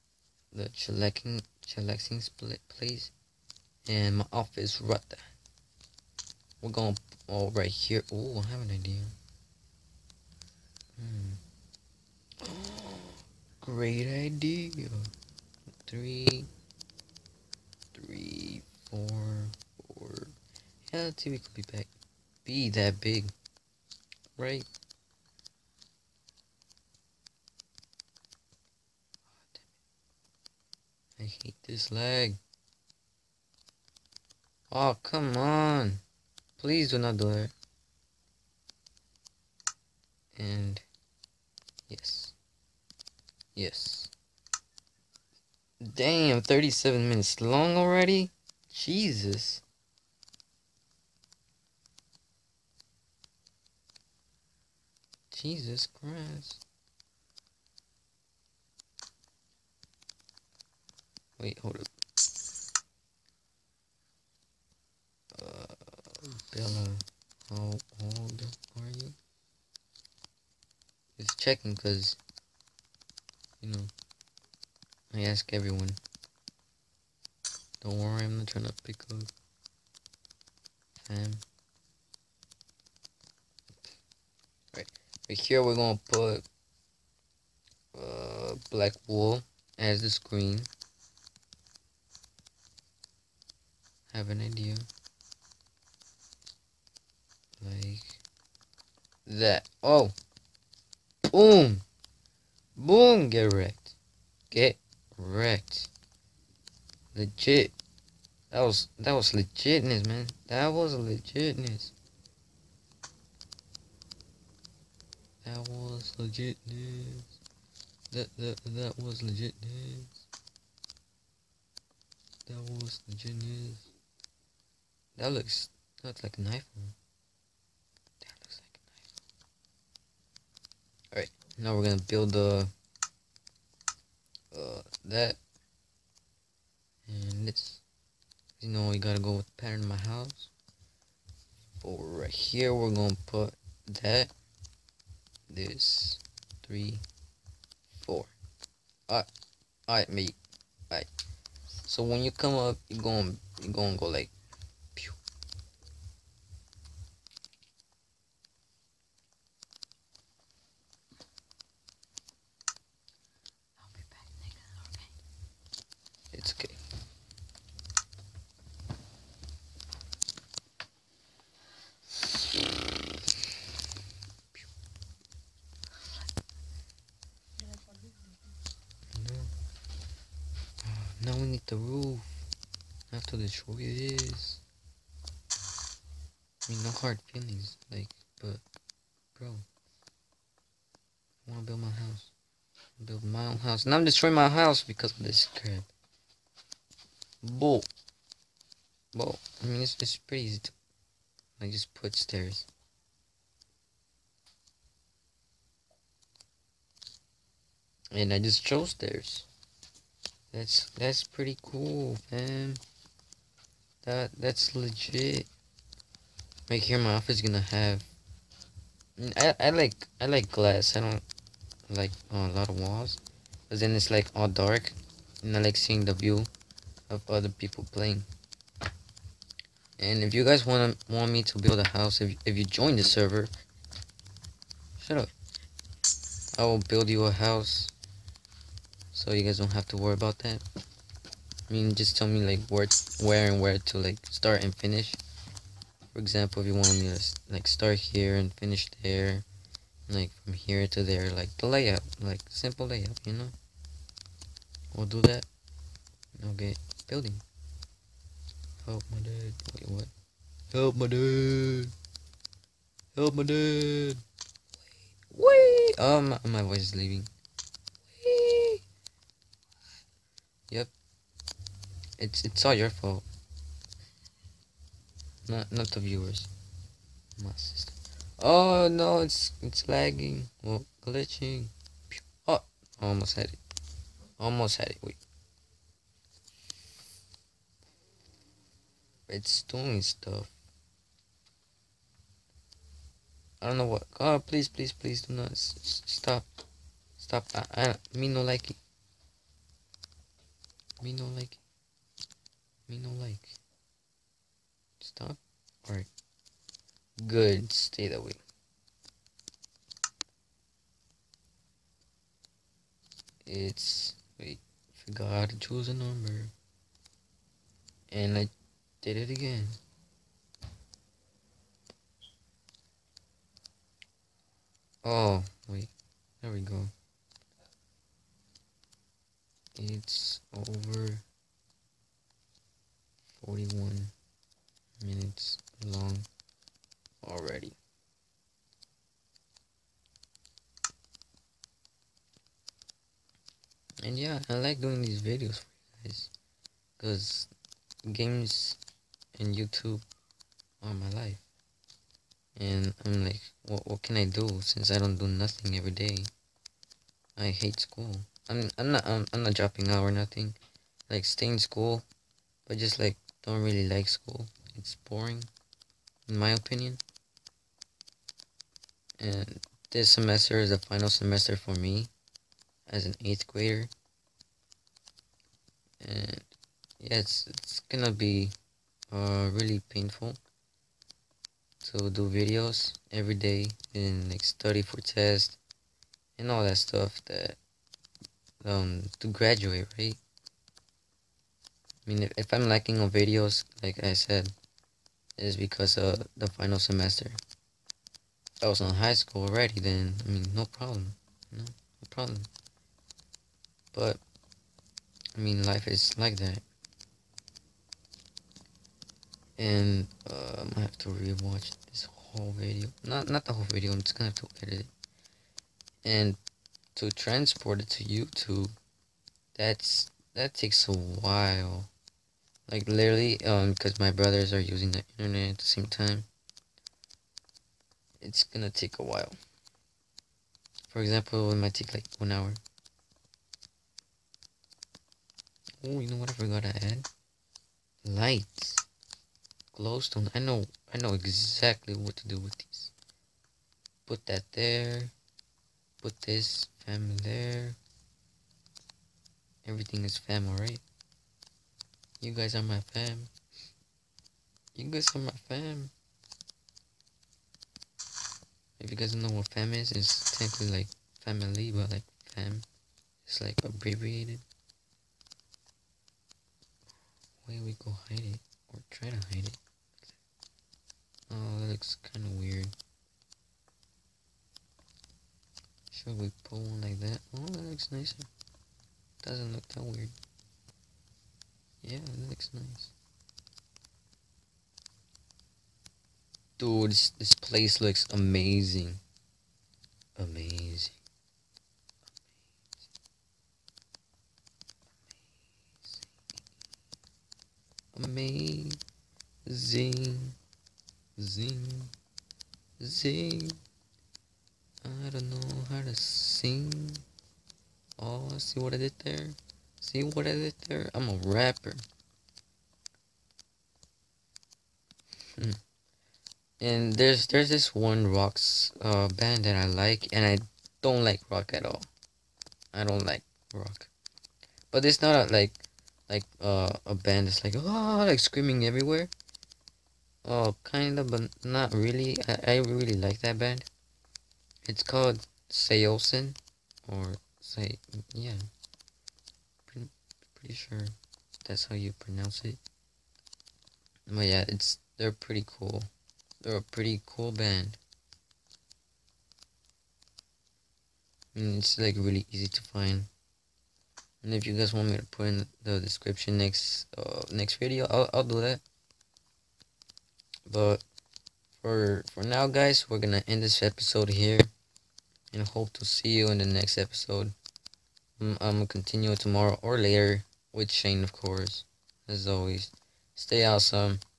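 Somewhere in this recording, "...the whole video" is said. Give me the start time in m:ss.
6:53.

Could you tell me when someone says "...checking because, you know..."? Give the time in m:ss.
1:11.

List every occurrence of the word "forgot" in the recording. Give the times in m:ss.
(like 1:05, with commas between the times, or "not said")
5:15, 7:16.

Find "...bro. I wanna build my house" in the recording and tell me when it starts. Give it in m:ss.
3:09.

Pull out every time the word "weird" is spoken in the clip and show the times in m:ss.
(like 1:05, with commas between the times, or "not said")
7:52, 7:59.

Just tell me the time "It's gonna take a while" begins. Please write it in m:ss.
7:08.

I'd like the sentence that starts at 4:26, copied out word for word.
um my voice is leaving Yep.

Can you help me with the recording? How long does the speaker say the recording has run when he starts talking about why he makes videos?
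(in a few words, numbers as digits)
41 minutes.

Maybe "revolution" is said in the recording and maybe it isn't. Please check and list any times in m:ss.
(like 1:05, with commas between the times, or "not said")
not said.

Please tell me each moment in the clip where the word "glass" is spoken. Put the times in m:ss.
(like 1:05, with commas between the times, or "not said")
3:40.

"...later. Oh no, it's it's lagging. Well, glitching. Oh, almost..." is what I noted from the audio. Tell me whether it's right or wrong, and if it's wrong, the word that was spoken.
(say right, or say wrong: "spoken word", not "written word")
wrong: "sister", not "later".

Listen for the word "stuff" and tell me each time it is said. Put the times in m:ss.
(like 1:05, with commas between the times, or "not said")
4:50, 6:26.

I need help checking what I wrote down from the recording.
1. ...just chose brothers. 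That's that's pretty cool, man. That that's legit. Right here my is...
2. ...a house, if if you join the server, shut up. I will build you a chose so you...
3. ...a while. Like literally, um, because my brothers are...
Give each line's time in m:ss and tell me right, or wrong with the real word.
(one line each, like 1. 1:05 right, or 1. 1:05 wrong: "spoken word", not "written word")
1. 3:28 wrong: "stairs", not "brothers"
2. 3:51 wrong: "house", not "chose"
3. 7:00 right.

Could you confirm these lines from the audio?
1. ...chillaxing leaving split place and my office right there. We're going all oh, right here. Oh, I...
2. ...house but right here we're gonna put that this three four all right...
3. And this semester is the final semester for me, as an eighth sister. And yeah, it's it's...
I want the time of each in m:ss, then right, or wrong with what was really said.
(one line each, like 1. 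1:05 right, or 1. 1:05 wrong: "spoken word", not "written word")
1. 0:00 wrong: "chillaxing", not "leaving"
2. 2:19 right
3. 6:09 wrong: "grader", not "sister".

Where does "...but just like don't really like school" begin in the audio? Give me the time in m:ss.
6:02.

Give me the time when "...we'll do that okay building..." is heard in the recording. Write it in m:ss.
4:14.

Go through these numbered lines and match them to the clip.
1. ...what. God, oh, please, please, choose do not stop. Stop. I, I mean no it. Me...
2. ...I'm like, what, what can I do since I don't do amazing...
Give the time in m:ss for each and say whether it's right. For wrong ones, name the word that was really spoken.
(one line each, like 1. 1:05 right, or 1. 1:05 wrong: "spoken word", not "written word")
1. 4:53 wrong: "please", not "choose"
2. 5:53 wrong: "nothing", not "amazing".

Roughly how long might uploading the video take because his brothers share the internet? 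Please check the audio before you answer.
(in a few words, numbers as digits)
1 hour.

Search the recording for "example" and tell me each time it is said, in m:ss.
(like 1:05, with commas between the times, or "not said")
4:06, 7:10.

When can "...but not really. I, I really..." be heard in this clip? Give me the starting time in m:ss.
8:51.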